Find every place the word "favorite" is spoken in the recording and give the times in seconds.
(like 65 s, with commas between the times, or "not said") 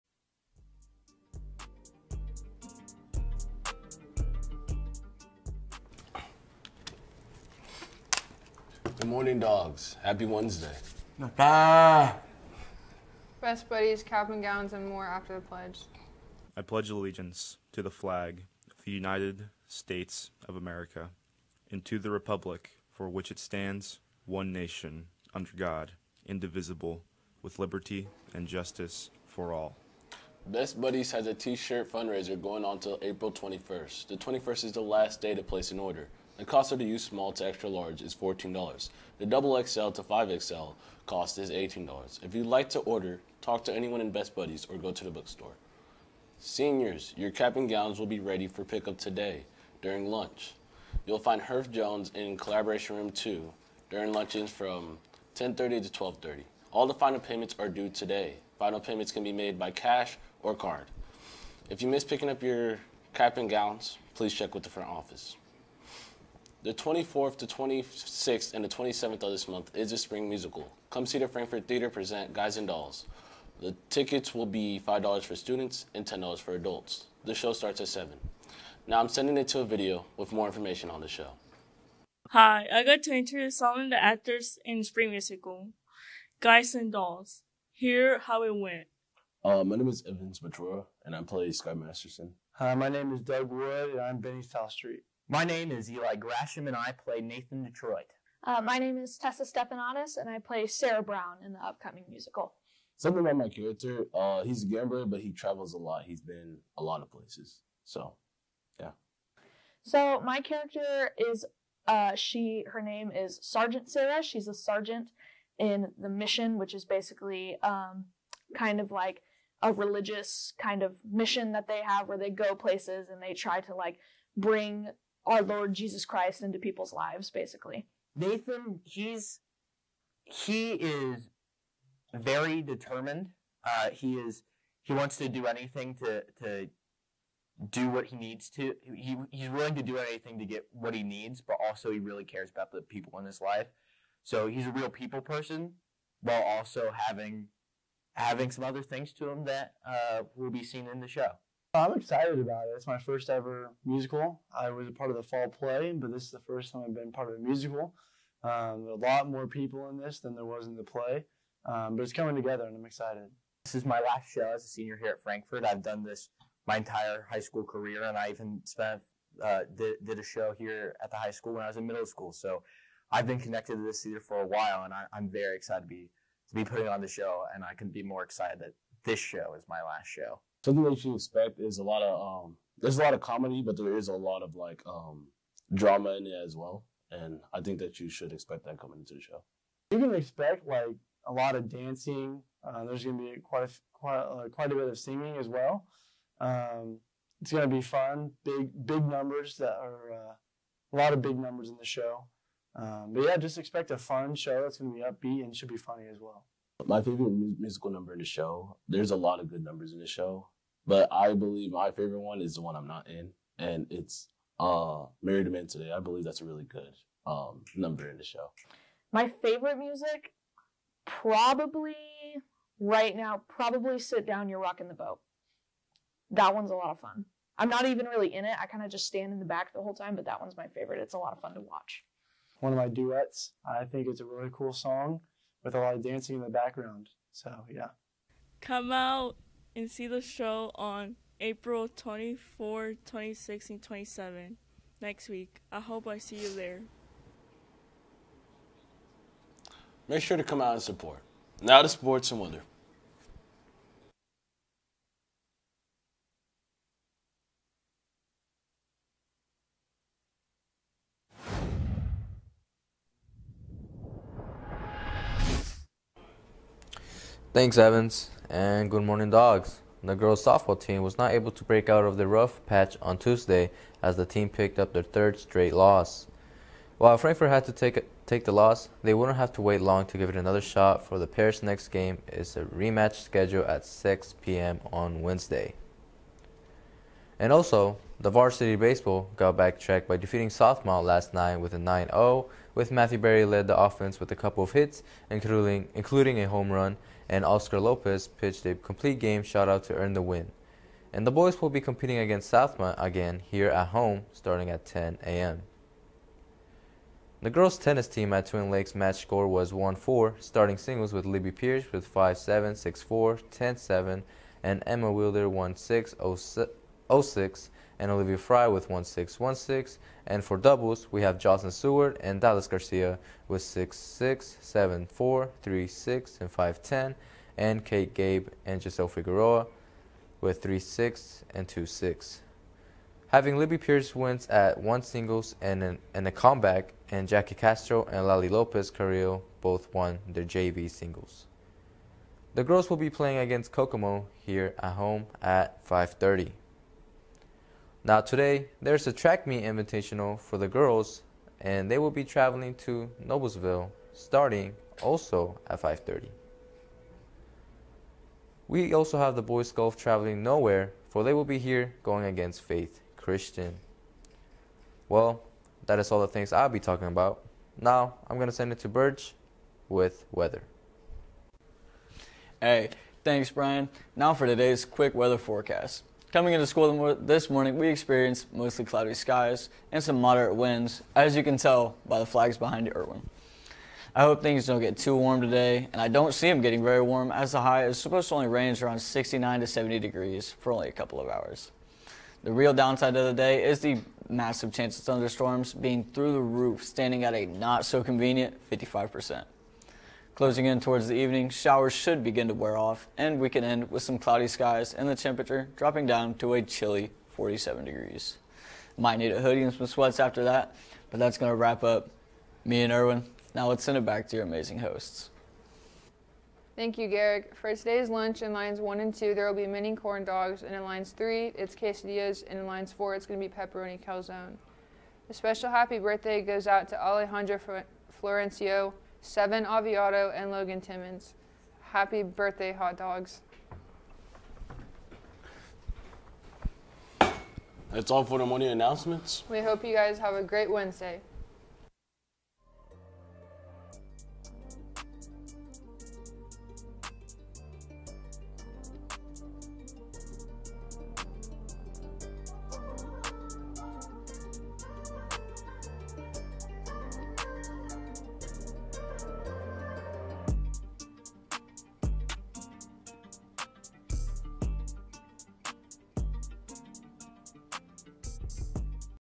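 207 s, 211 s, 219 s, 230 s.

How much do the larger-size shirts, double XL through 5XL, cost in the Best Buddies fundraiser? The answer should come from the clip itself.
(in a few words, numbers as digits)
$18.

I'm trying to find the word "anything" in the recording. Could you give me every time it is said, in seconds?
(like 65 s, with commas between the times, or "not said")
135 s, 139 s.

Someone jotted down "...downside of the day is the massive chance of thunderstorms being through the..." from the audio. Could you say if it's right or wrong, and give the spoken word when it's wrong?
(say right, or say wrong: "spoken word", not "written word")
right.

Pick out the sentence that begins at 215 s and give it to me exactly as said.
I believe that's a really good um, number in the show.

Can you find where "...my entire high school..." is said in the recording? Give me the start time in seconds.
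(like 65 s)
166 s.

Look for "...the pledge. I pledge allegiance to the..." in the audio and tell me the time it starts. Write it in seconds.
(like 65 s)
15 s.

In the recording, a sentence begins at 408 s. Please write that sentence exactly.
Might need a hoodie and some sweats after that, but that's going to wrap up me and Erwin.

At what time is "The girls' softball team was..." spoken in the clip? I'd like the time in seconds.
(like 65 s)
270 s.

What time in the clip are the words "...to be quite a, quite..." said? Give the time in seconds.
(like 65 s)
193 s.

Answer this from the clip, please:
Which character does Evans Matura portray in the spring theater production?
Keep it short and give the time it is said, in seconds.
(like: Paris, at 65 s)
Sky Masterson, at 91 s.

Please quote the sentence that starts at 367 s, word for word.
Now, I'm going to send it to Birch with weather.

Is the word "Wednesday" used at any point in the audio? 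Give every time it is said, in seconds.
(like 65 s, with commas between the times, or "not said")
10 s, 285 s, 440 s.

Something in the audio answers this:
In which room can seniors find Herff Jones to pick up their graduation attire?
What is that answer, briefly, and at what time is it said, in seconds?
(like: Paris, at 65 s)
Collaboration Room 2, at 52 s.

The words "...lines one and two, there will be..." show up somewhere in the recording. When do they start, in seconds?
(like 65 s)
418 s.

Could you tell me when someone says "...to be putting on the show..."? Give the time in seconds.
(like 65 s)
176 s.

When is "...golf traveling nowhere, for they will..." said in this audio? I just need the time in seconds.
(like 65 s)
359 s.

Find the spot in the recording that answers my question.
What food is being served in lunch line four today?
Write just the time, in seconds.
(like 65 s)
423 s.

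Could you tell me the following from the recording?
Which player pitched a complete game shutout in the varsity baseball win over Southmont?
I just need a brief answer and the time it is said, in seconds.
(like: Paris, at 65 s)
Oscar Lopez, at 297 s.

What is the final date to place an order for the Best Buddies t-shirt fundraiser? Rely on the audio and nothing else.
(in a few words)
April 21st.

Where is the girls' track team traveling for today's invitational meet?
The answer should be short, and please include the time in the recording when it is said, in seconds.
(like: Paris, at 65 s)
Noblesville, at 353 s.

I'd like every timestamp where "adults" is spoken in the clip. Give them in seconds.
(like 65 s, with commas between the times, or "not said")
76 s.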